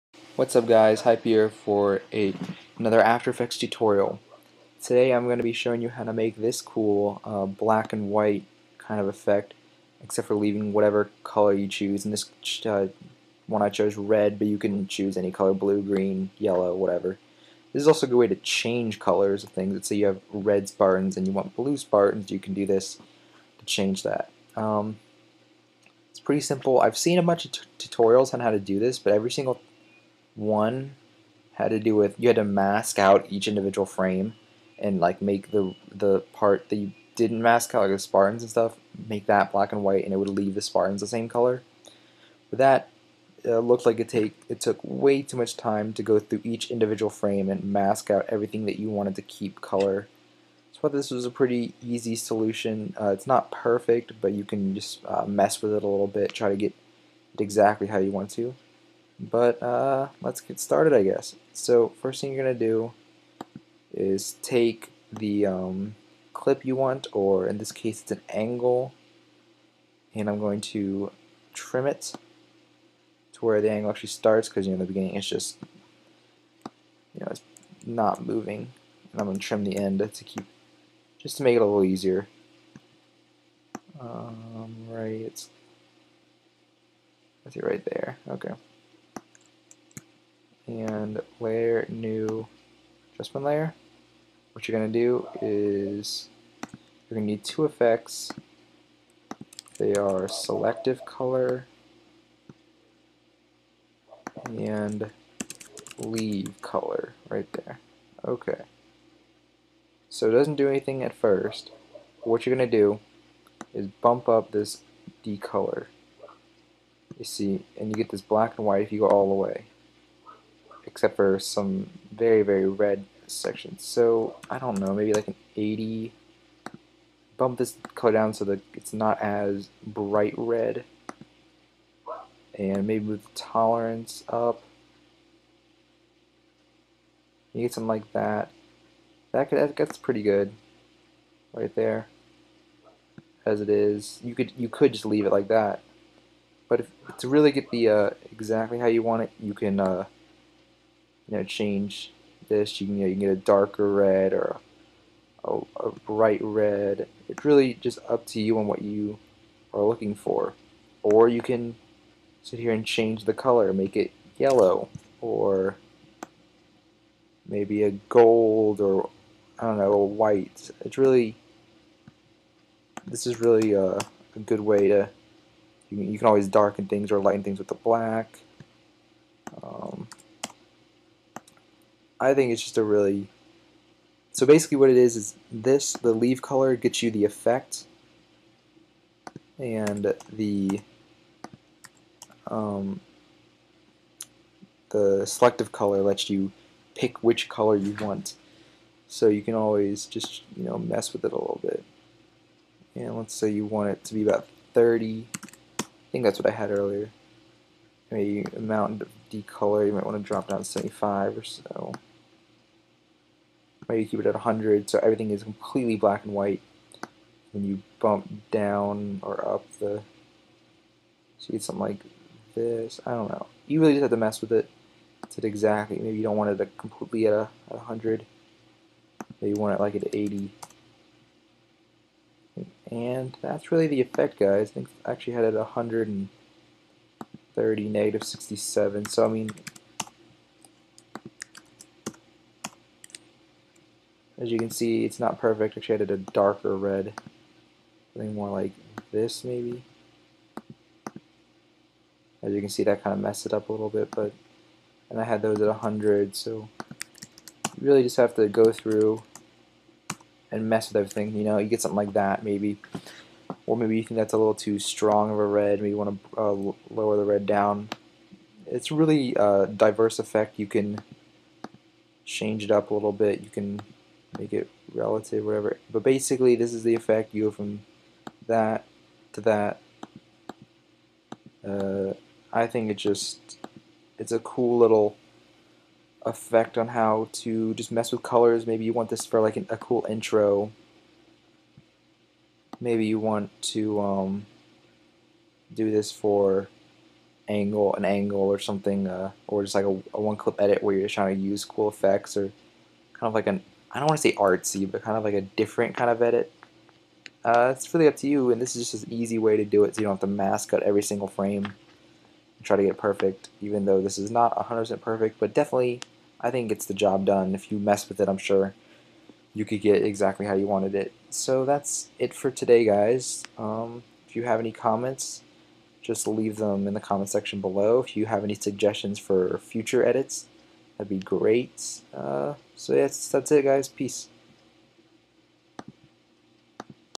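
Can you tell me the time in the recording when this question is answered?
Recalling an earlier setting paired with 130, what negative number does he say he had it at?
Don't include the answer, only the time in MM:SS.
03:57.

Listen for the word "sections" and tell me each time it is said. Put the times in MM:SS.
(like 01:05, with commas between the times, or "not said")
02:03, 05:27.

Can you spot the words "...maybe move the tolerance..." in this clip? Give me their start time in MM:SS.
02:12.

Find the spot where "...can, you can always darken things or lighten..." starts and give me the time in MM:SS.
02:55.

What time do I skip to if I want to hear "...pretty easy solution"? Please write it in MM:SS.
00:51.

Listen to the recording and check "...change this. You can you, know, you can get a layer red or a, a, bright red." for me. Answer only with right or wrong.
wrong.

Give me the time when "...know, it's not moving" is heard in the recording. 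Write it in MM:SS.
01:17.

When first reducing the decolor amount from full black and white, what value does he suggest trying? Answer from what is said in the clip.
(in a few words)
80.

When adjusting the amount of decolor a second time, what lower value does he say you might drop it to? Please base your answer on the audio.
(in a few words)
75.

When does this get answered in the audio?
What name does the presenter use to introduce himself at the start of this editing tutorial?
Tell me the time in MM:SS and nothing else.
00:01.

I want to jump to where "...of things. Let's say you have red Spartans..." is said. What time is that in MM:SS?
00:19.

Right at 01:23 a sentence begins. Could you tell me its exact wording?
Um, right, it's, I see right there, okay and layer new adjustment layer.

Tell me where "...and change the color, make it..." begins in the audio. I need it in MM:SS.
02:42.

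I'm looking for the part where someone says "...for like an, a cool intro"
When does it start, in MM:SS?
04:49.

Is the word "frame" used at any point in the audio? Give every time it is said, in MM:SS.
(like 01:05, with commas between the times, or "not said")
00:33, 00:47, 05:11.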